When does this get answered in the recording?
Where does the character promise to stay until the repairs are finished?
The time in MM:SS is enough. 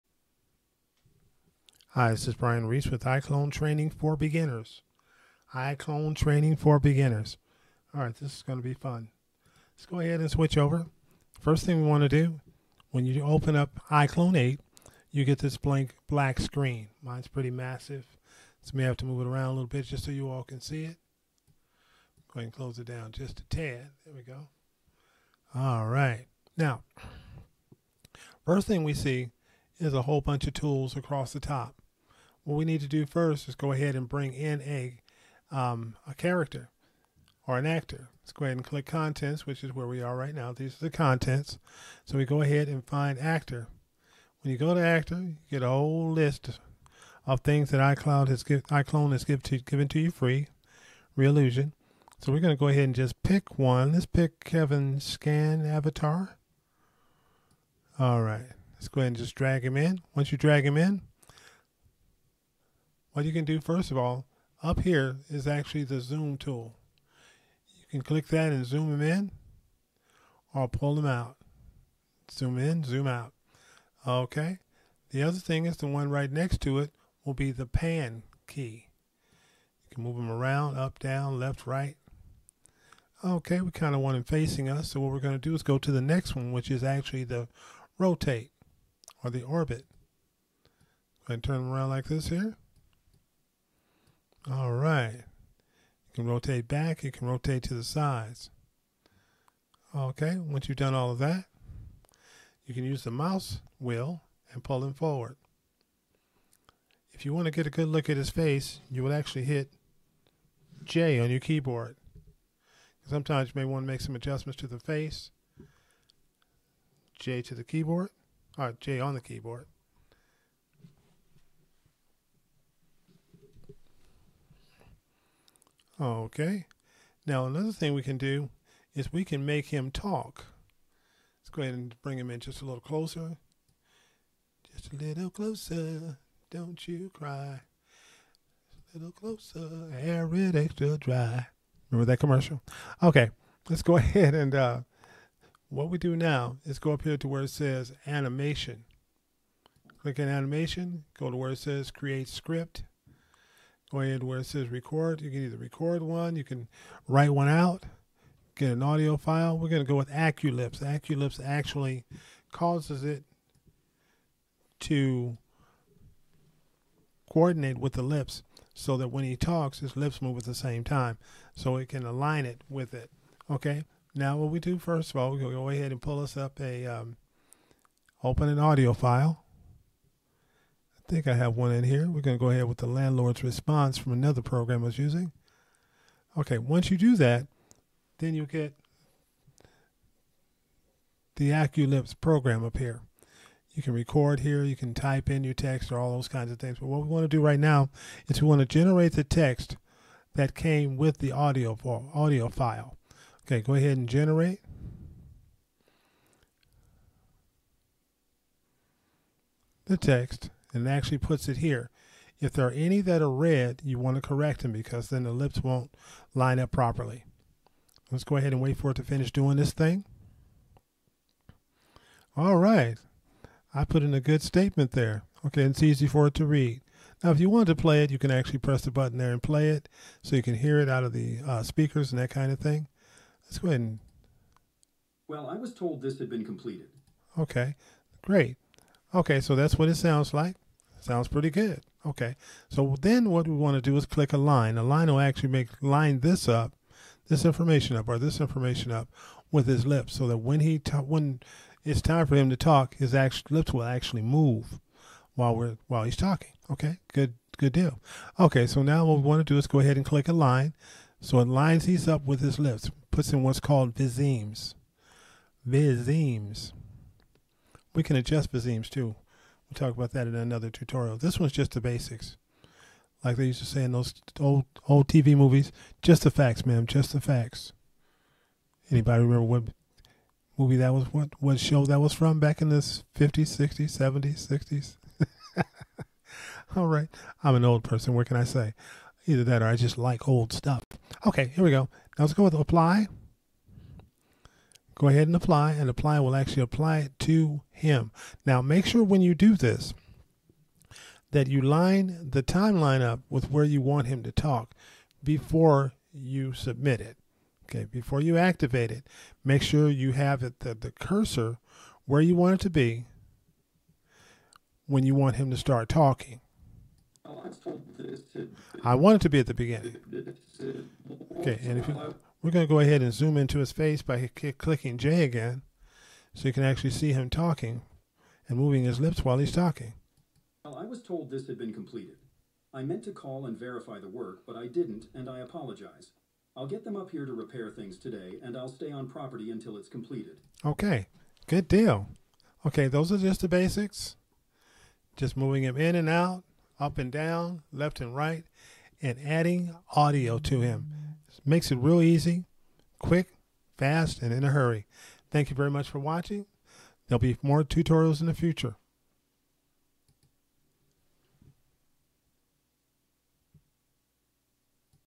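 05:38.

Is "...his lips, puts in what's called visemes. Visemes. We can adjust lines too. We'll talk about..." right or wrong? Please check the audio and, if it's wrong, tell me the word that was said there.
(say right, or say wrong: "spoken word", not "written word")
wrong: "visemes", not "lines".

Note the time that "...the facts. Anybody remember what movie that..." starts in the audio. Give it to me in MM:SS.
04:37.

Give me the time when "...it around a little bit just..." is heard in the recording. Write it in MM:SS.
00:19.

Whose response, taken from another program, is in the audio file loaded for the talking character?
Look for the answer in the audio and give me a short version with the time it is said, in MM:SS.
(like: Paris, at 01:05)
The landlord's, at 03:02.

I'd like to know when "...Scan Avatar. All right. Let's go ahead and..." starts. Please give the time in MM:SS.
00:54.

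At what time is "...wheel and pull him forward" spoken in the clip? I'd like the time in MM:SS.
01:43.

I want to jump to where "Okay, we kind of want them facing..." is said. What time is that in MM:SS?
01:23.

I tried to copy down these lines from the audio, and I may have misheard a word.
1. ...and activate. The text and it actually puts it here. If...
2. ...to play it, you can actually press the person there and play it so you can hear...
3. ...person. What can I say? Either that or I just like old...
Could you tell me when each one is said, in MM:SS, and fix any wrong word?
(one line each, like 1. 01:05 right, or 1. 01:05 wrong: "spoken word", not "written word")
1. 03:23 wrong: "generate", not "activate"
2. 03:47 wrong: "button", not "person"
3. 04:47 right.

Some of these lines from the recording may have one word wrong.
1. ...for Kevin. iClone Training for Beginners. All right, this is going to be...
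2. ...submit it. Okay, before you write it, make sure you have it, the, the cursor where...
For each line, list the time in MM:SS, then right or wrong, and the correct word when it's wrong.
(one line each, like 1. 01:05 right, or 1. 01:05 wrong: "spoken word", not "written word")
1. 00:03 wrong: "Beginners", not "Kevin"
2. 05:06 wrong: "activate", not "write".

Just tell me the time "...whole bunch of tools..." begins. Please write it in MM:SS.
00:30.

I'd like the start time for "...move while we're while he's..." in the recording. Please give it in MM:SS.
04:14.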